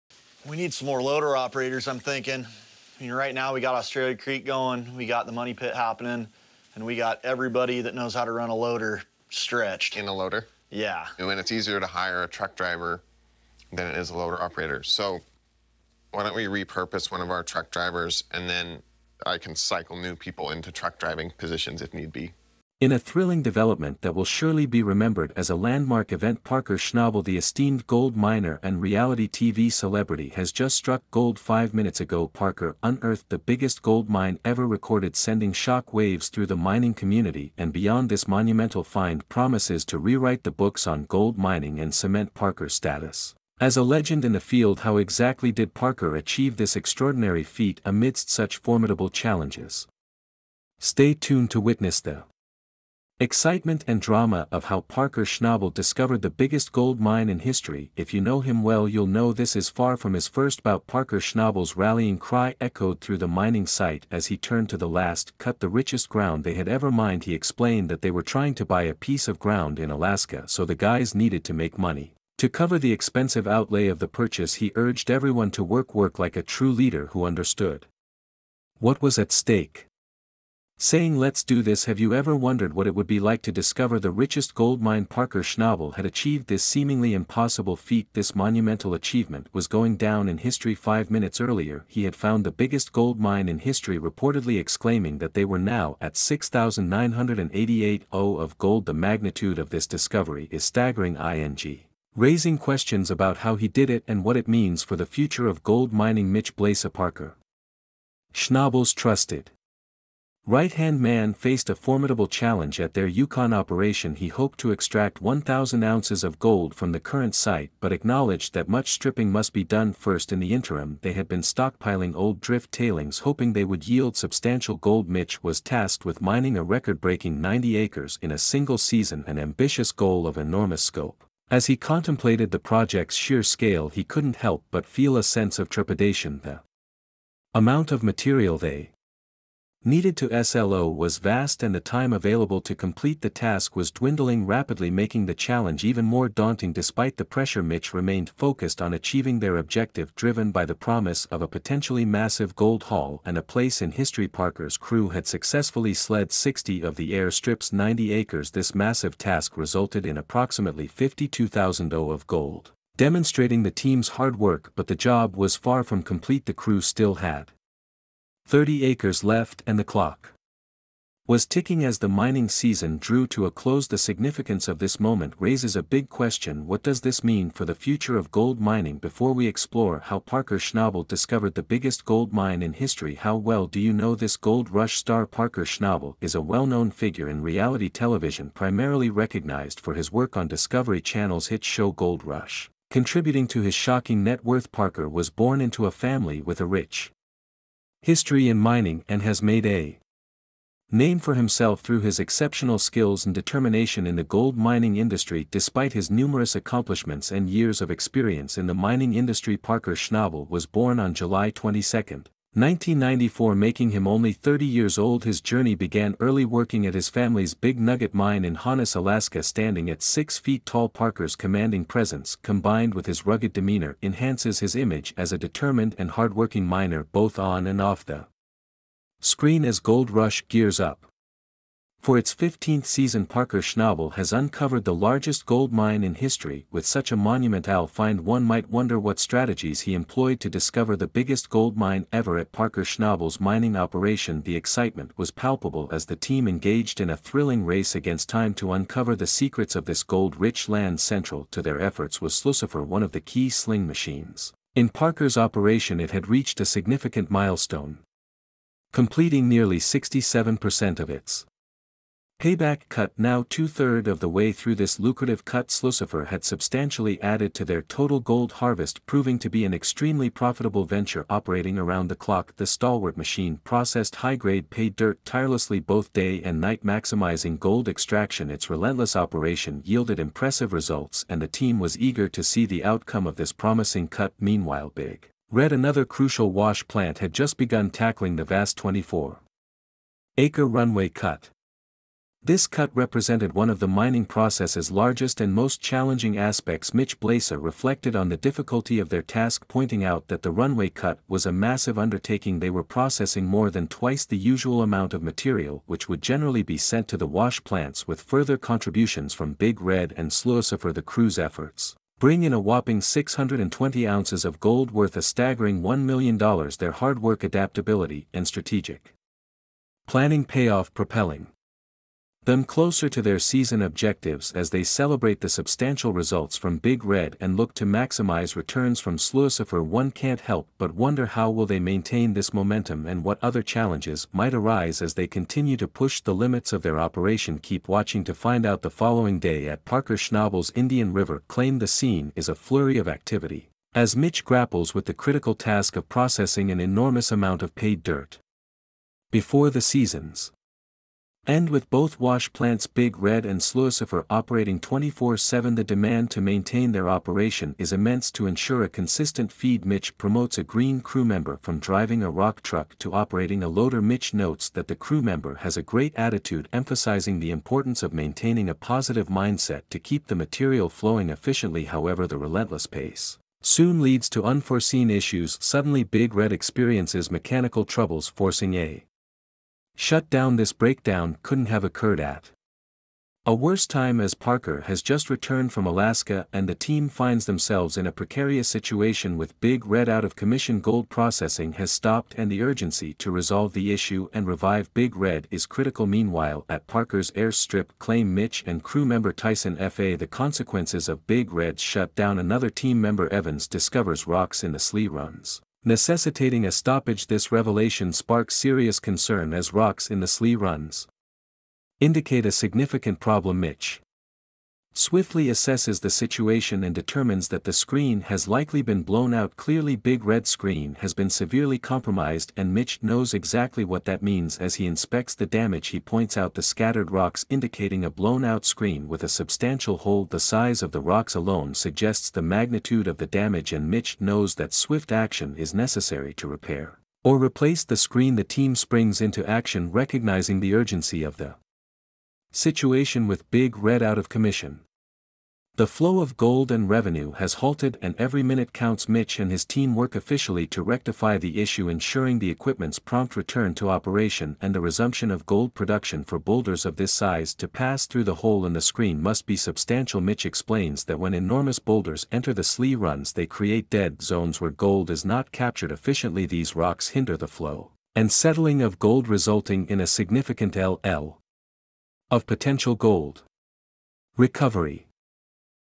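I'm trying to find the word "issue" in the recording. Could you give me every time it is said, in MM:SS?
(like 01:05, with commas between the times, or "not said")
06:15, 06:33, 07:31.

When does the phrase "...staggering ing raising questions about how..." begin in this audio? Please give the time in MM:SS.
01:40.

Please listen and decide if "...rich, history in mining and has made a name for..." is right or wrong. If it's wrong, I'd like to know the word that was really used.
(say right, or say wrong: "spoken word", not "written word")
right.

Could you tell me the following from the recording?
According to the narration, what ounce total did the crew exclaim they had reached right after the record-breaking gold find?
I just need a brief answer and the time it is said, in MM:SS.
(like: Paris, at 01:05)
6,988 ounces, at 01:36.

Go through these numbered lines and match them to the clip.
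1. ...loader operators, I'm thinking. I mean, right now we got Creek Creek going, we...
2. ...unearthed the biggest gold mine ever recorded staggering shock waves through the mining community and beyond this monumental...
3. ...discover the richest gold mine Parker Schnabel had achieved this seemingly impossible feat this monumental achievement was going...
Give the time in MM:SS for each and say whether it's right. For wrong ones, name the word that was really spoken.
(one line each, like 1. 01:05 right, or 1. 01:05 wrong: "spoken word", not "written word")
1. 00:01 wrong: "Australia", not "Creek"
2. 00:32 wrong: "sending", not "staggering"
3. 01:23 right.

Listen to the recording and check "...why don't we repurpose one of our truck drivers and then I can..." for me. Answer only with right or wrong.
right.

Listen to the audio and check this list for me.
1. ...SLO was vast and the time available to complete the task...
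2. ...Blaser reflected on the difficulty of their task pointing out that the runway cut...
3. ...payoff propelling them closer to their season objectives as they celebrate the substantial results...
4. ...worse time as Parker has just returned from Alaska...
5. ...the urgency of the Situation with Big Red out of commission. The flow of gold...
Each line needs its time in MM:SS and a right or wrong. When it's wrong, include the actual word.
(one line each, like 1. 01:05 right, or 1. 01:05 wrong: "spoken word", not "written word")
1. 02:20 right
2. 04:57 right
3. 05:20 right
4. 06:23 right
5. 07:20 right.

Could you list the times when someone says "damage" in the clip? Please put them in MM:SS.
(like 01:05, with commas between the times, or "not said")
07:05, 07:13.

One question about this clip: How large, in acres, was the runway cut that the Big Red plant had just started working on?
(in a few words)
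24 acres.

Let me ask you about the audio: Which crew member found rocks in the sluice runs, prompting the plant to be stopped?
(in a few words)
Evans.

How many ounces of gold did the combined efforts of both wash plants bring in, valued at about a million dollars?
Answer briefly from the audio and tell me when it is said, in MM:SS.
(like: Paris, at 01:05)
620 ounces, at 05:13.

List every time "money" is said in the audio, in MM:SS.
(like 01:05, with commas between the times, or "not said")
00:05, 01:11.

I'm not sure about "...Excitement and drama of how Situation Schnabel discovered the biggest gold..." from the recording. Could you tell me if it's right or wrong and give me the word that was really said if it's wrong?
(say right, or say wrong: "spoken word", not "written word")
wrong: "Parker", not "Situation".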